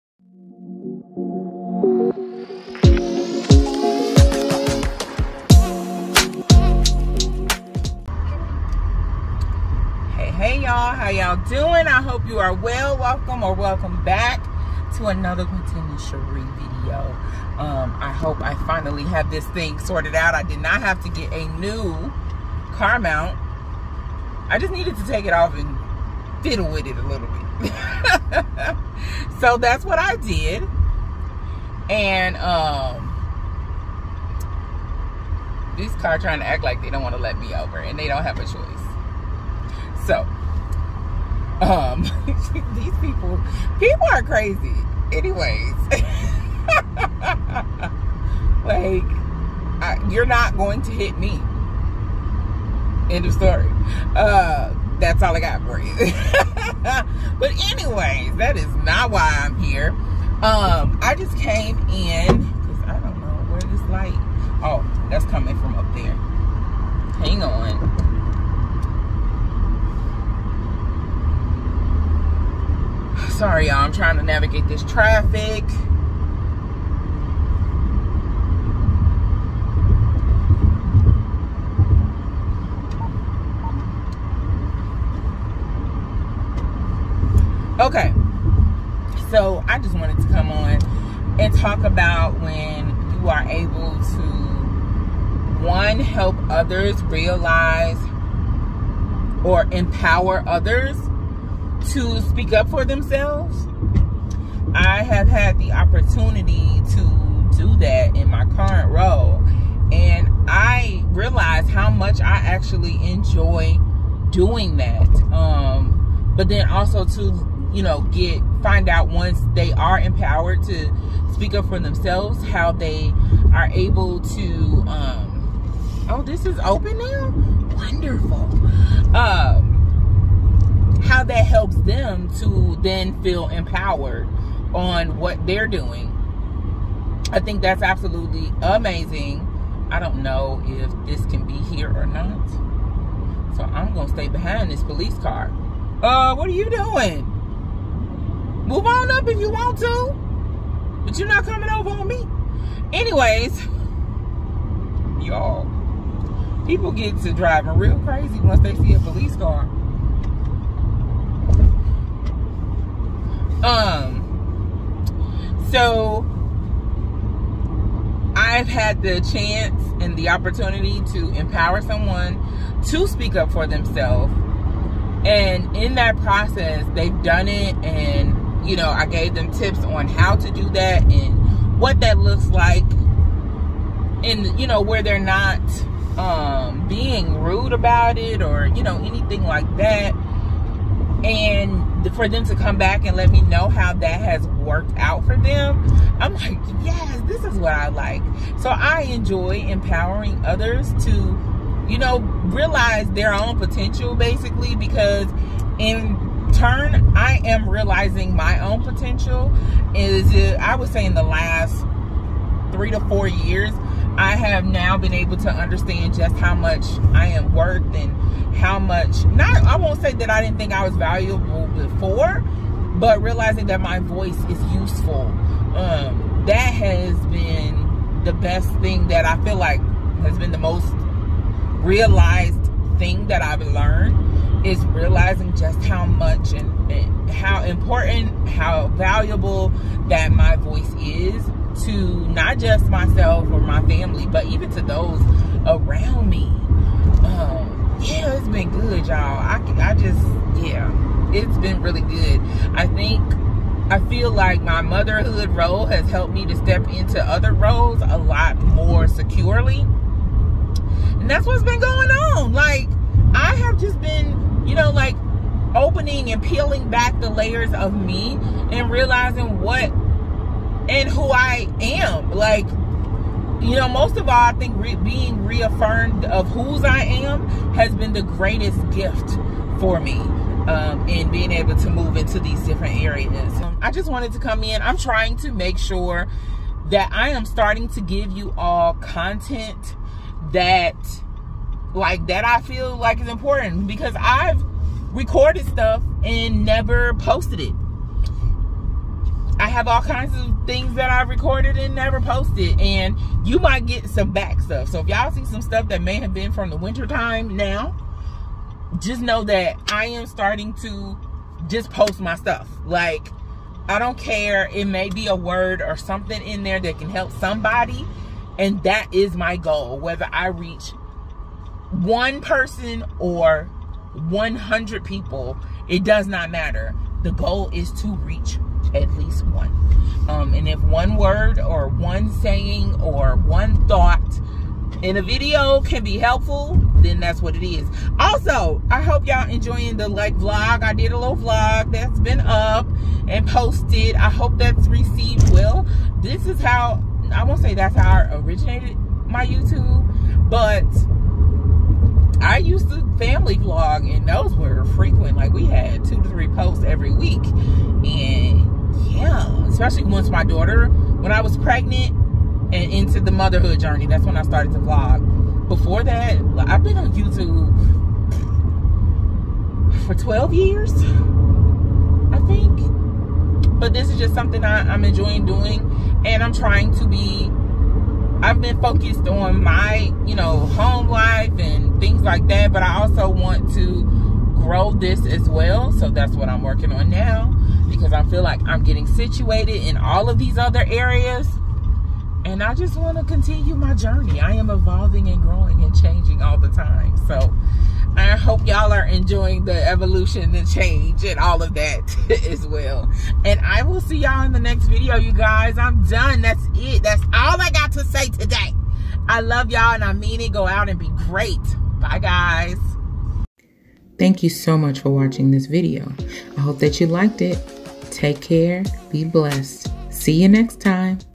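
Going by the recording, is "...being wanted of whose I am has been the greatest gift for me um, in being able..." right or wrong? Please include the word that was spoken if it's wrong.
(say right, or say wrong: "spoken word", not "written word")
wrong: "reaffirmed", not "wanted".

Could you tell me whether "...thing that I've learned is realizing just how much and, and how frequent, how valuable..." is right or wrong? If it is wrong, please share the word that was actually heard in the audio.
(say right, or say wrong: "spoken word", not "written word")
wrong: "important", not "frequent".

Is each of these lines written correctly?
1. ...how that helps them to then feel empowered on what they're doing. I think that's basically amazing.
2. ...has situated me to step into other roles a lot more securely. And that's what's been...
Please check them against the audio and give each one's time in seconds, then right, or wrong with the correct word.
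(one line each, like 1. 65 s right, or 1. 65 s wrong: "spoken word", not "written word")
1. 131 s wrong: "absolutely", not "basically"
2. 255 s wrong: "helped", not "situated".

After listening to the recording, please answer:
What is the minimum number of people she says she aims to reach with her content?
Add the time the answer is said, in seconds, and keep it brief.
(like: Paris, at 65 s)
1, at 328 s.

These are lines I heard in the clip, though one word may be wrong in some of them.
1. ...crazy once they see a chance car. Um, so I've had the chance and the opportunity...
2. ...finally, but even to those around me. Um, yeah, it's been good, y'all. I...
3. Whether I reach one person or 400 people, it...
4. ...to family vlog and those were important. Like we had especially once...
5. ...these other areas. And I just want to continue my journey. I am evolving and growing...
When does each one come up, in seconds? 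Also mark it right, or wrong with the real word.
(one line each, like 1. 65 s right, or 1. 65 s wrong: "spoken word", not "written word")
1. 157 s wrong: "police", not "chance"
2. 243 s wrong: "family", not "finally"
3. 319 s wrong: "100", not "400"
4. 352 s wrong: "frequent", not "important"
5. 390 s right.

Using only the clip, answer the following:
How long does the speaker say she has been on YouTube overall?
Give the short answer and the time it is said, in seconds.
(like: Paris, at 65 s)
12 years, at 370 s.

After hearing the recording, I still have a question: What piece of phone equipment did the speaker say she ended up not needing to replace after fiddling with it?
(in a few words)
Car mount.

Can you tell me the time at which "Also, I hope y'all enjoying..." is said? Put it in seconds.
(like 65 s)
338 s.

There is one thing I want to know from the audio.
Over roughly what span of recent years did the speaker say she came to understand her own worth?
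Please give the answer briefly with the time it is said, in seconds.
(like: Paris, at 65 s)
3 to 4 years, at 212 s.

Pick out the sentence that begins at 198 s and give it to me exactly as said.
So I enjoy empowering others to, you know, realize their own potential basically because in turn, I am realizing my own potential.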